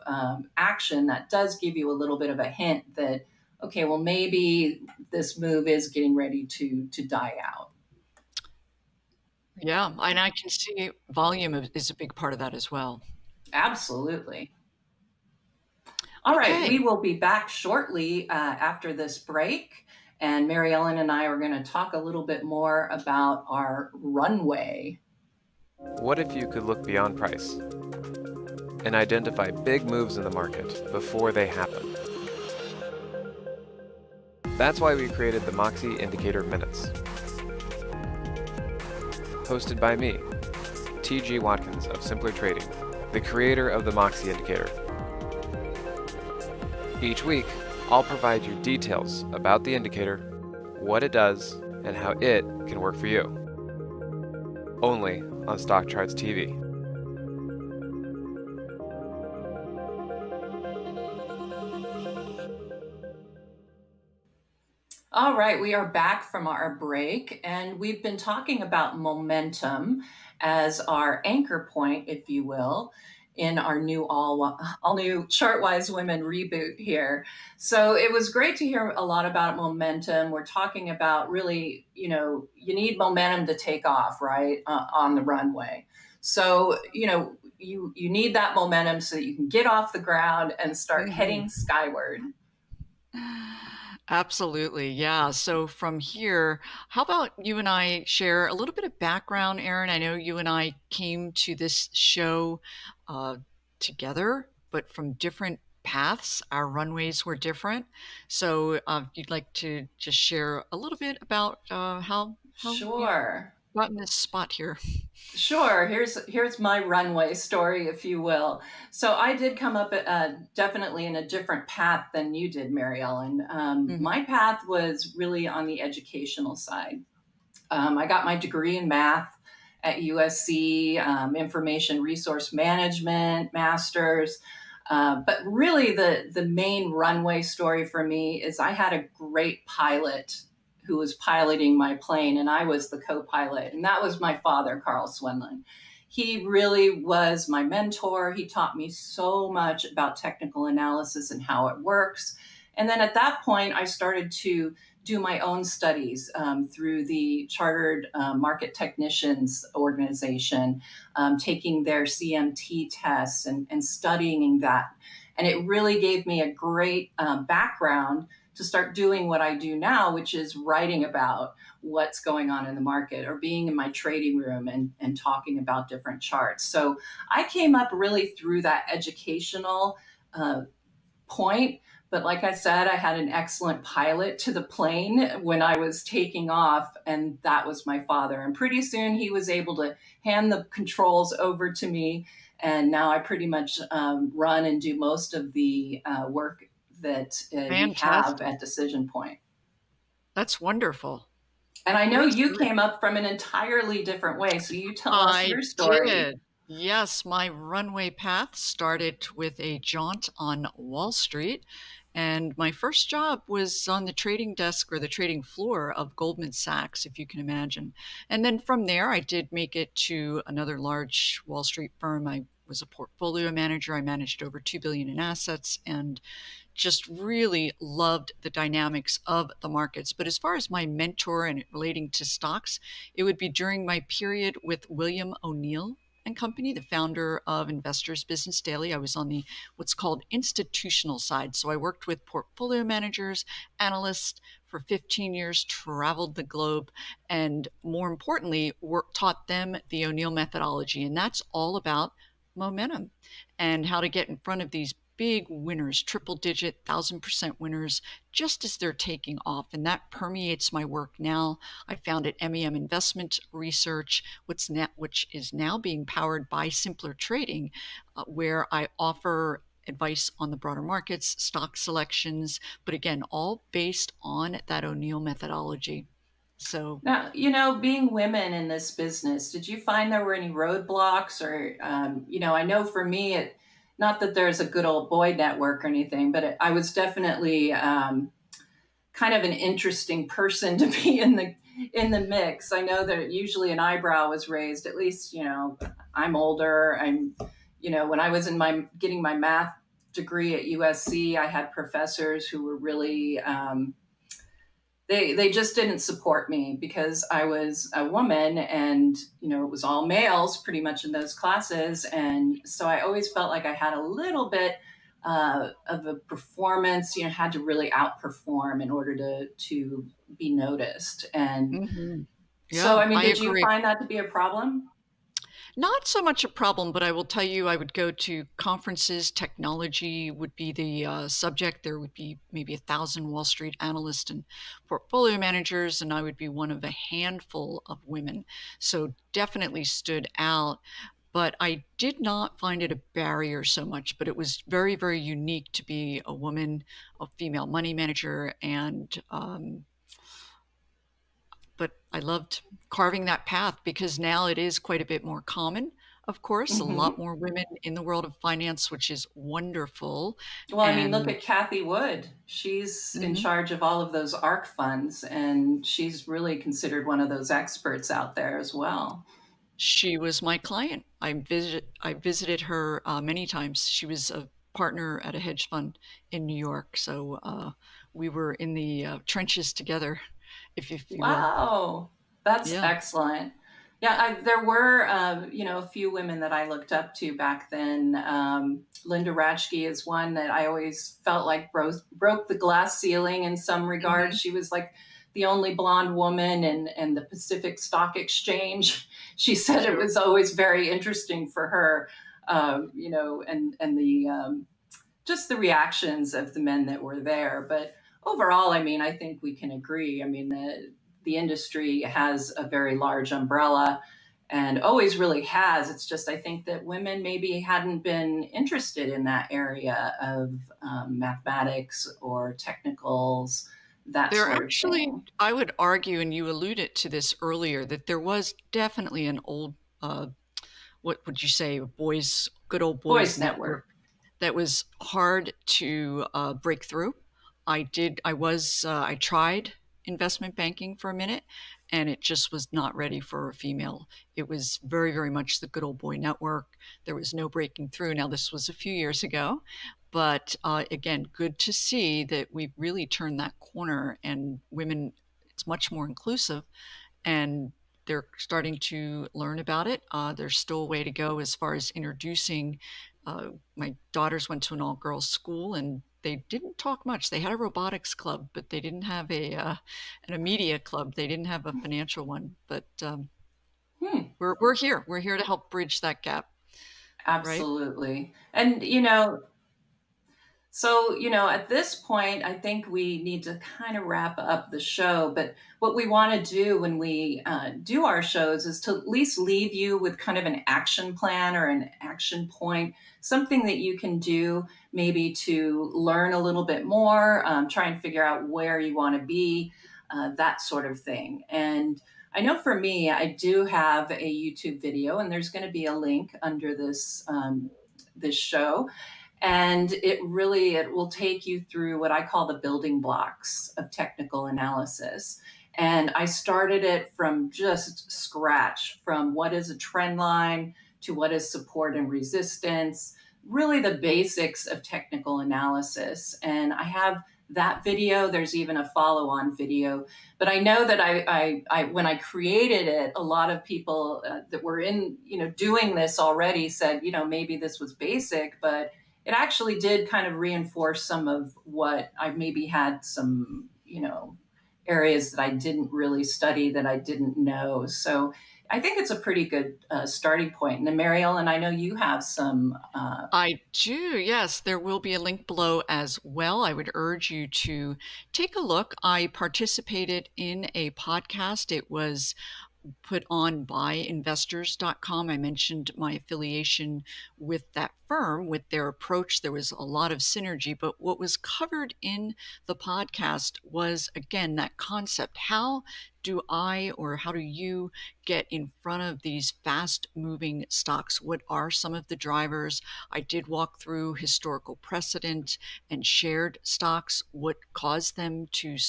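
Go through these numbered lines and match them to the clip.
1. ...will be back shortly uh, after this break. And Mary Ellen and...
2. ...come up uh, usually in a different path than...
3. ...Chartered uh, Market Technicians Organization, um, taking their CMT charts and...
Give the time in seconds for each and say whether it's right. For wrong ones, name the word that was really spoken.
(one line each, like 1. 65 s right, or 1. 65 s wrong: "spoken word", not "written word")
1. 16 s right
2. 119 s wrong: "definitely", not "usually"
3. 157 s wrong: "tests", not "charts".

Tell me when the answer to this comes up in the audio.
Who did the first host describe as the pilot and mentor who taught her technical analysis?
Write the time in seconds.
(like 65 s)
144 s.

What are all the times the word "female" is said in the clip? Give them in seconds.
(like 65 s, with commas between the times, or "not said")
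347 s, 443 s.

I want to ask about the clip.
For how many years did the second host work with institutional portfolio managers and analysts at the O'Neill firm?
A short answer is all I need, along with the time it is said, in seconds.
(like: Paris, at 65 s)
15 years, at 244 s.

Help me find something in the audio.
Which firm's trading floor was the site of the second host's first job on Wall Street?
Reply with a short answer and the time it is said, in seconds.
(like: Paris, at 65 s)
Goldman Sachs, at 216 s.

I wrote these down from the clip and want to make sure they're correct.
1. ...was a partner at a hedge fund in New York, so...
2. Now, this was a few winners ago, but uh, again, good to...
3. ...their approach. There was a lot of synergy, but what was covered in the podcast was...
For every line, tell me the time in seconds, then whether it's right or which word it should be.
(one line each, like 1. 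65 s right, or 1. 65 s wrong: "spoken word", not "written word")
1. 374 s right
2. 448 s wrong: "years", not "winners"
3. 568 s right.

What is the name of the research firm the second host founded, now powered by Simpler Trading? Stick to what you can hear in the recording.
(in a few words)
MEM Investment Research.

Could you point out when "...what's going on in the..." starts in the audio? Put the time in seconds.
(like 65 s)
171 s.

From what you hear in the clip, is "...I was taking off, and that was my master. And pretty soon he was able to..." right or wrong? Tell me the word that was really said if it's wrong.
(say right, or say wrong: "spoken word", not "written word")
wrong: "father", not "master".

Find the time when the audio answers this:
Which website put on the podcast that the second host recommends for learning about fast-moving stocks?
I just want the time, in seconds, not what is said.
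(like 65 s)
563 s.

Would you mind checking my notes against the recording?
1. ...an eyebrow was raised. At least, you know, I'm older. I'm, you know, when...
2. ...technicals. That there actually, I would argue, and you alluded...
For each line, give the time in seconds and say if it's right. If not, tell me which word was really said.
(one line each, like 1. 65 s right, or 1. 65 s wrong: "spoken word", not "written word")
1. 293 s right
2. 422 s right.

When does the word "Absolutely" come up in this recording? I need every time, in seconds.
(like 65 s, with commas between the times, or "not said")
13 s, 94 s, 477 s.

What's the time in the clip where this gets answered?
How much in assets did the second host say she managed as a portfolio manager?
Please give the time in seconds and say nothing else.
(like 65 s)
224 s.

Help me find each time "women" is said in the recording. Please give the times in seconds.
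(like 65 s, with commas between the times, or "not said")
75 s, 278 s, 338 s, 357 s, 386 s, 416 s, 454 s.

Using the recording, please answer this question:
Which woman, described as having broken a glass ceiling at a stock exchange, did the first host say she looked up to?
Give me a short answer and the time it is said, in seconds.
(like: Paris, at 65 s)
Linda Raschke, at 389 s.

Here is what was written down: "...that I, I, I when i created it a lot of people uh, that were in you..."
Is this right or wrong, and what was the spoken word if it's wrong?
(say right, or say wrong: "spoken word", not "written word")
right.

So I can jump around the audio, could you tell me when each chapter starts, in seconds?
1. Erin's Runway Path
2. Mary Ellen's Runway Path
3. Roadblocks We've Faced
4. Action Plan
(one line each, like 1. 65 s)
1. 115 s
2. 205 s
3. 277 s
4. 488 s.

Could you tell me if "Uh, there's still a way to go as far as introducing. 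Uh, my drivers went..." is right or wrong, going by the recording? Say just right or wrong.
wrong.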